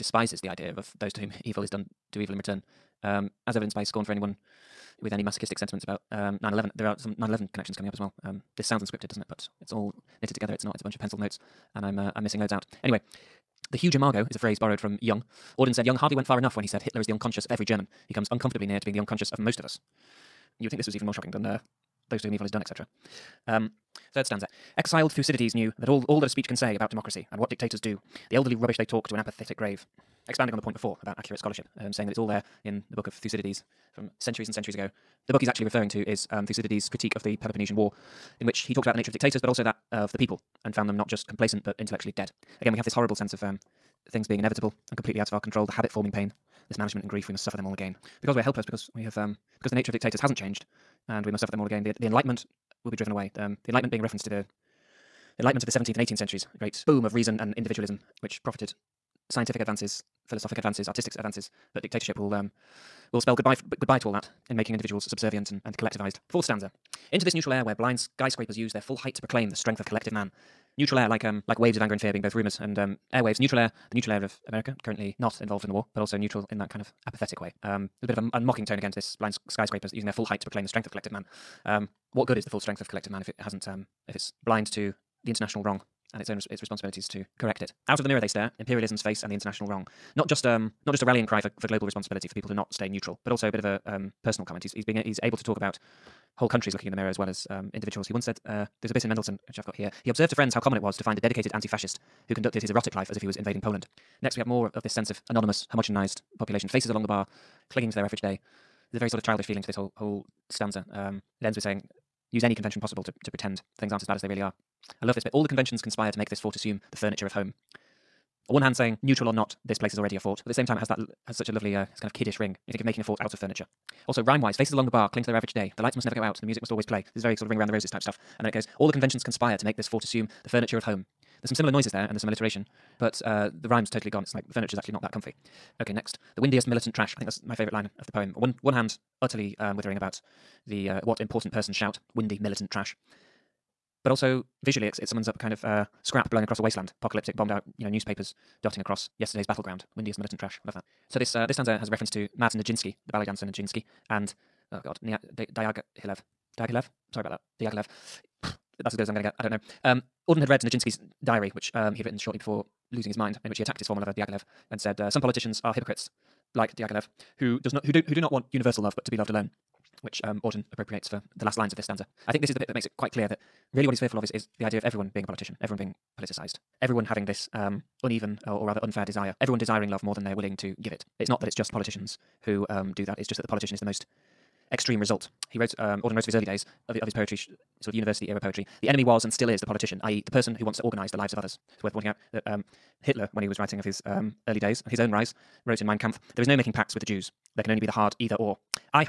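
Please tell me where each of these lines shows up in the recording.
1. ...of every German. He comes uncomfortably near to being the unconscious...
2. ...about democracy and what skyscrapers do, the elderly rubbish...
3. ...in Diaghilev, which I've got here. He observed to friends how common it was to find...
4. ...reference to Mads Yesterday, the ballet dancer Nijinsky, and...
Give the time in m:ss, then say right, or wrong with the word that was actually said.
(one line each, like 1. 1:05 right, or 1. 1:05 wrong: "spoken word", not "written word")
1. 0:17 right
2. 0:26 wrong: "dictators", not "skyscrapers"
3. 1:39 wrong: "Mendelson", not "Diaghilev"
4. 2:31 wrong: "Nijinsky", not "Yesterday".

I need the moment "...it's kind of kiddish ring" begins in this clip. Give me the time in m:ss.
2:01.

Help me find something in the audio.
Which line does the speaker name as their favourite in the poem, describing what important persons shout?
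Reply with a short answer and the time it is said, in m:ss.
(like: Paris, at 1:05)
The windiest militant trash, at 2:16.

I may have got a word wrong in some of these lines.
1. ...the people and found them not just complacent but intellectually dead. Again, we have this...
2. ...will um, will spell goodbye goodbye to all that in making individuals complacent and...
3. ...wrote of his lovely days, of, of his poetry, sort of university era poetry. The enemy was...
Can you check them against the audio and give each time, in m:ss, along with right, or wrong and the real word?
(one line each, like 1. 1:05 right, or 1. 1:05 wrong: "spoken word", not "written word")
1. 0:40 right
2. 1:02 wrong: "subservient", not "complacent"
3. 3:06 wrong: "early", not "lovely".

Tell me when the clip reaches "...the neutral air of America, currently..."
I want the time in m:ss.
1:13.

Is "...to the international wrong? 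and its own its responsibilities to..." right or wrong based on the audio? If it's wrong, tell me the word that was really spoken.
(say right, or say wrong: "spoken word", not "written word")
right.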